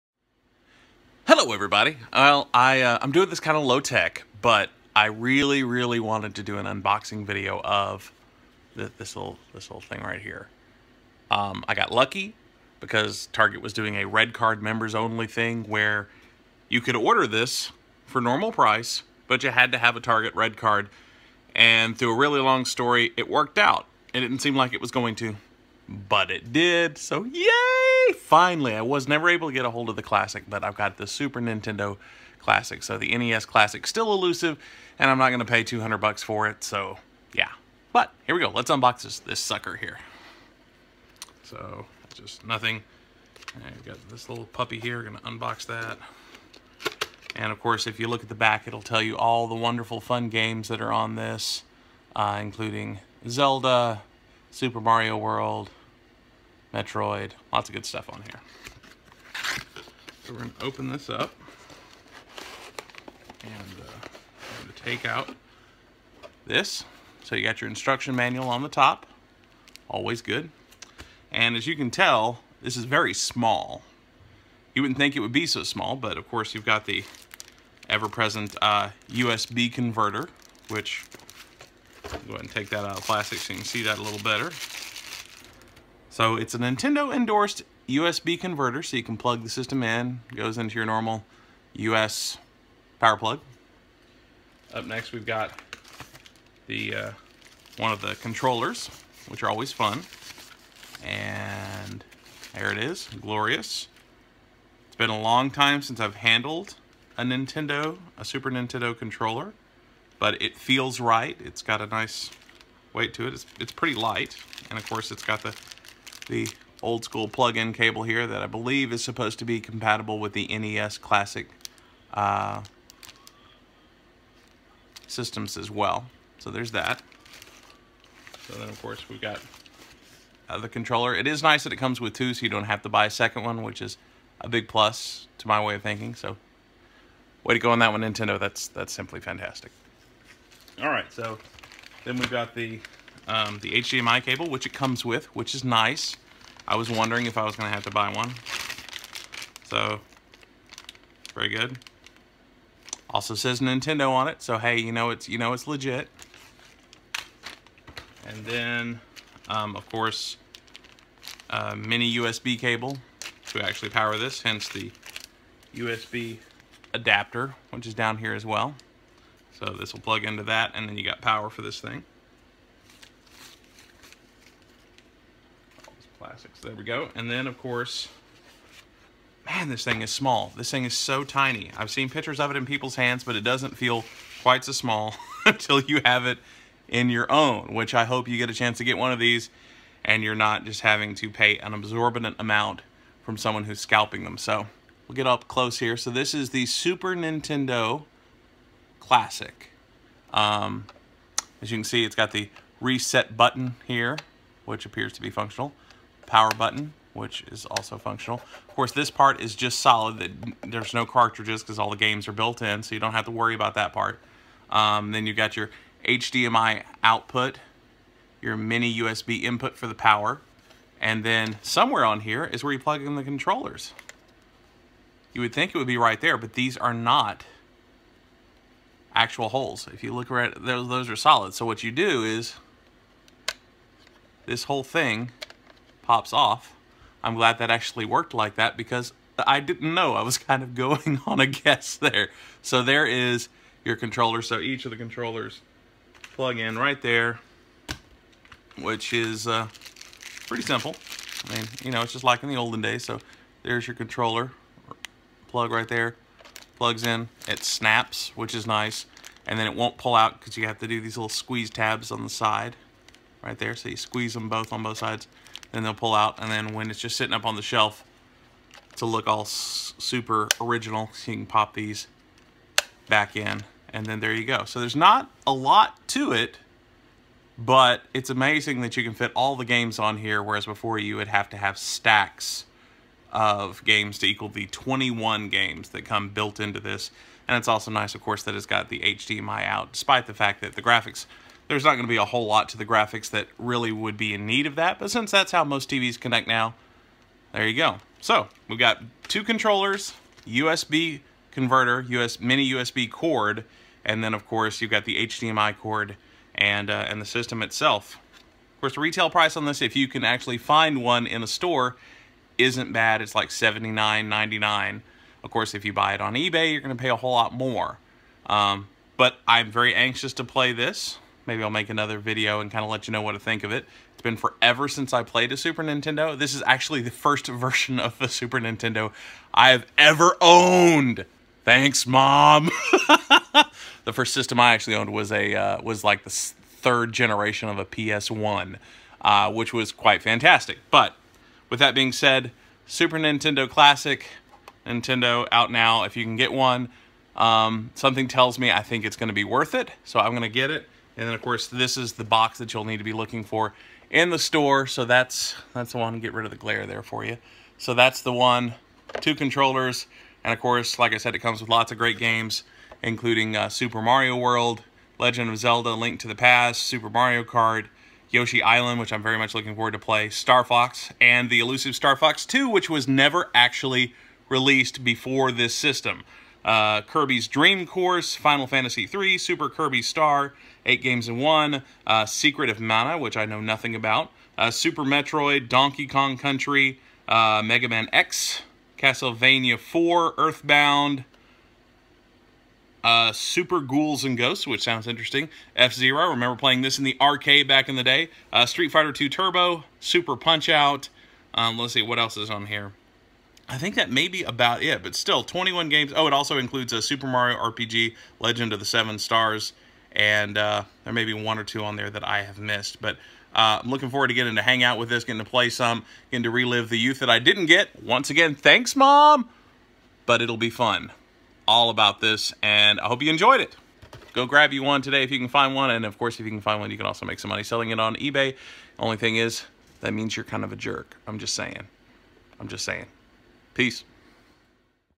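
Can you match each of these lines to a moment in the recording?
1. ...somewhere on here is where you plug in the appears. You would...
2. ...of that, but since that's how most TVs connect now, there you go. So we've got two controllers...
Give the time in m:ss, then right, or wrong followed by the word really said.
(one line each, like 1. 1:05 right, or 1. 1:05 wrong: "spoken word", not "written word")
1. 3:41 wrong: "controllers", not "appears"
2. 4:54 right.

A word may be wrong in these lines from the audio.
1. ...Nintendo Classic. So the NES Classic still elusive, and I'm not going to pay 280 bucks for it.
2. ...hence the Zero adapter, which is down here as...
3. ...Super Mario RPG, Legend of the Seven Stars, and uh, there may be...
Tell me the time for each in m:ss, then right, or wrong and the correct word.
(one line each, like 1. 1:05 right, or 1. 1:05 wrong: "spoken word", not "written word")
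1. 0:31 wrong: "200", not "280"
2. 2:44 wrong: "USB", not "Zero"
3. 6:47 right.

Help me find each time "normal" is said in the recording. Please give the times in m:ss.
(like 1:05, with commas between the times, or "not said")
0:18, 1:30.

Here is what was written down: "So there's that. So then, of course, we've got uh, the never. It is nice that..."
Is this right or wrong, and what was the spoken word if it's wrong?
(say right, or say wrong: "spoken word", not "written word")
wrong: "controller", not "never".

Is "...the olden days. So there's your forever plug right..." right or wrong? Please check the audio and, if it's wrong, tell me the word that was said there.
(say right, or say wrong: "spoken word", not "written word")
wrong: "controller", not "forever".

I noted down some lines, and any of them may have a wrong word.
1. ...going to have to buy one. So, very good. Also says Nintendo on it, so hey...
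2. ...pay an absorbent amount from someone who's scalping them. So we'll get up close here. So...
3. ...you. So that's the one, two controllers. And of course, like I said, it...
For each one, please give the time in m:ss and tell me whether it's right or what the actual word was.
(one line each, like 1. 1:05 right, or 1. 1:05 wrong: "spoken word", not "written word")
1. 2:27 right
2. 3:11 right
3. 5:57 right.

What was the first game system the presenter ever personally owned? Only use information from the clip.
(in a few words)
PS1.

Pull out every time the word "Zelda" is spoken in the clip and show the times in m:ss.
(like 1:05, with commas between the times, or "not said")
0:53, 6:05.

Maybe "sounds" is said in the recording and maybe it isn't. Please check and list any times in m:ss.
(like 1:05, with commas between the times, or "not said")
6:34.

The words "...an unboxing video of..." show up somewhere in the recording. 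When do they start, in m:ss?
0:06.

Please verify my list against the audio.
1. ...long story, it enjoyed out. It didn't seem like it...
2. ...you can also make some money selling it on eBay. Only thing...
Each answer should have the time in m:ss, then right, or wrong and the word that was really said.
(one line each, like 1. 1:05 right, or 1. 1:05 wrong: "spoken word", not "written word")
1. 0:22 wrong: "worked", not "enjoyed"
2. 7:06 right.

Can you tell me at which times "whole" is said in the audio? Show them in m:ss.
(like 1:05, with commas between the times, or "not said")
3:54, 4:52, 5:17.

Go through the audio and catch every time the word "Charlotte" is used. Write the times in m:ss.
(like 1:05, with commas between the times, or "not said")
not said.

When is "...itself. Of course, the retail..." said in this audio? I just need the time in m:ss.
5:07.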